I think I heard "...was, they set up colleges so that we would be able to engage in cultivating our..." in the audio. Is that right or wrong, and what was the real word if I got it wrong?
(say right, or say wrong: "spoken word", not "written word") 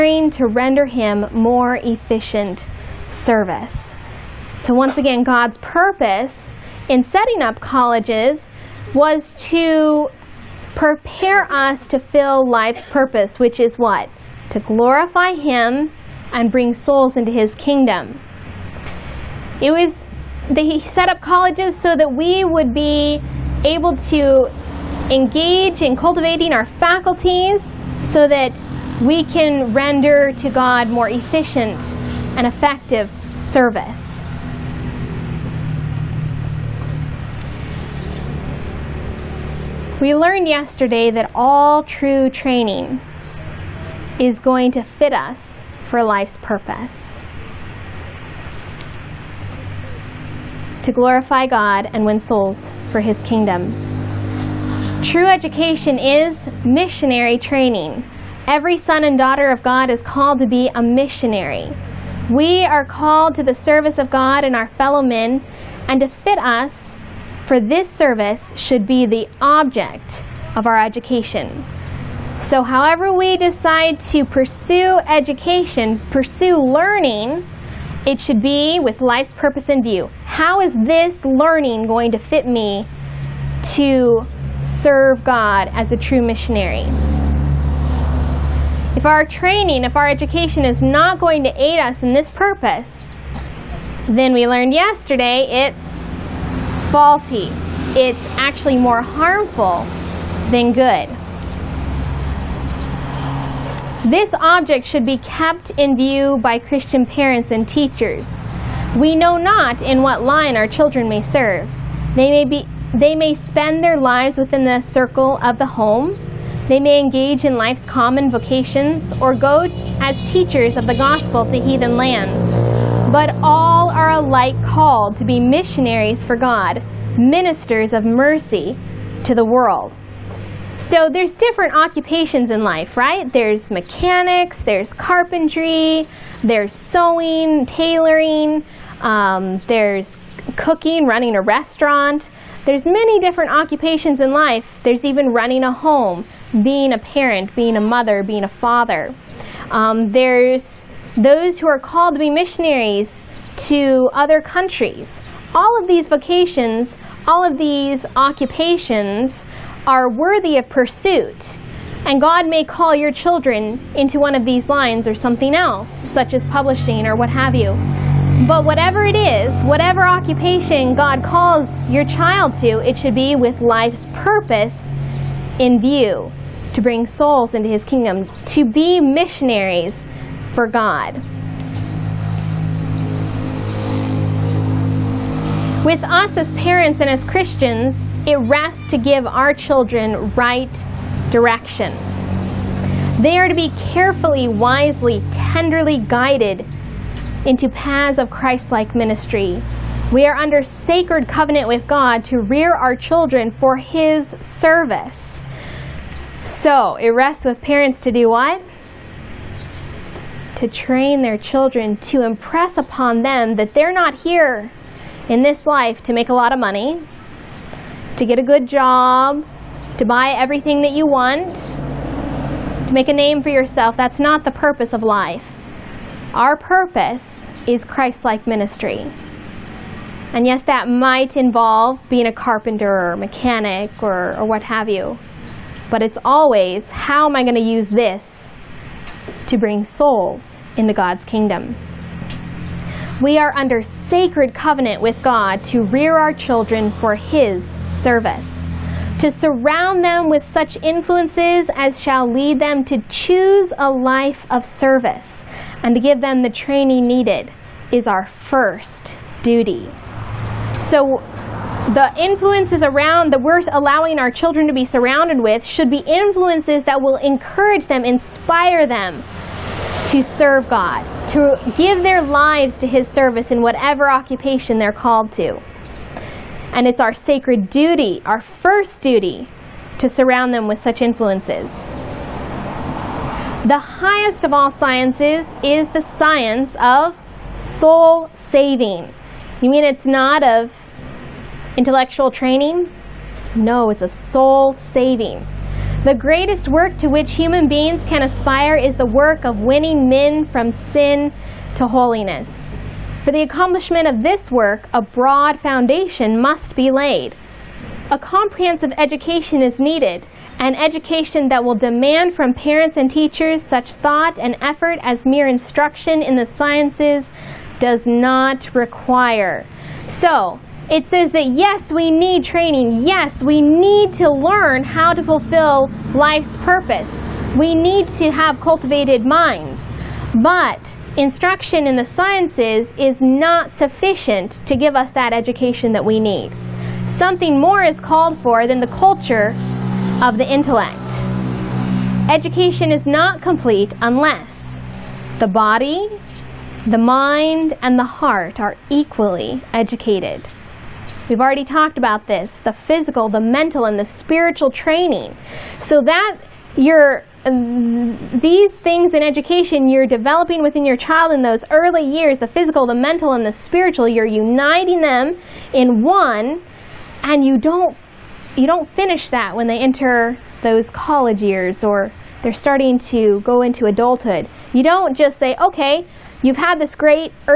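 right.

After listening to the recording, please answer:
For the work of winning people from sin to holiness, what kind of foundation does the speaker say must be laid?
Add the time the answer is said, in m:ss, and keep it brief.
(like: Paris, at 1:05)
A broad foundation, at 5:05.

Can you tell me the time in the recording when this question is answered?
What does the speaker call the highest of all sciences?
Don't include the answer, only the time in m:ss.
4:46.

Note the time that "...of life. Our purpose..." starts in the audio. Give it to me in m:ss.
3:44.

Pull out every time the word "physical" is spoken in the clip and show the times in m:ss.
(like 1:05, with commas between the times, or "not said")
5:52, 6:02.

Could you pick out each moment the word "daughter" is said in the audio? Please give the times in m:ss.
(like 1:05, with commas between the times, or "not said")
0:59.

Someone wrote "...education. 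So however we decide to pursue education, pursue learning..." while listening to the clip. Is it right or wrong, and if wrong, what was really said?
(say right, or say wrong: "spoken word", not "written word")
right.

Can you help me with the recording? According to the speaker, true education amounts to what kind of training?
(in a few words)
Missionary training.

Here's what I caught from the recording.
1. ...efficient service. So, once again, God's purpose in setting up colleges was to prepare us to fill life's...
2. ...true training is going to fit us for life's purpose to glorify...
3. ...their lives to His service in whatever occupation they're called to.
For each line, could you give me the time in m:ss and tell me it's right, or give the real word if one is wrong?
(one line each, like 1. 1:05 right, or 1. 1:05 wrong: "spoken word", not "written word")
1. 0:01 right
2. 0:41 right
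3. 4:32 right.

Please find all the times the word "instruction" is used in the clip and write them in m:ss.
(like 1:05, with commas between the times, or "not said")
5:15, 5:31.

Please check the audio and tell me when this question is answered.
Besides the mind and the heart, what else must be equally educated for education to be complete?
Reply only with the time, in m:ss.
5:45.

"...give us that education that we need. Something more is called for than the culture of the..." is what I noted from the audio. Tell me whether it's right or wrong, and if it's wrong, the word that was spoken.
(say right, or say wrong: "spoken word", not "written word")
right.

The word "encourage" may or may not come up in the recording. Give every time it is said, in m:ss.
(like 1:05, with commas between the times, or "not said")
4:27.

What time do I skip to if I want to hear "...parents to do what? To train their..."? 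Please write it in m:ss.
3:27.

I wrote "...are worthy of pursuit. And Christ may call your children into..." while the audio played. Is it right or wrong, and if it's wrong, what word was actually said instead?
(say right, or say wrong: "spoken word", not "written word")
wrong: "God", not "Christ".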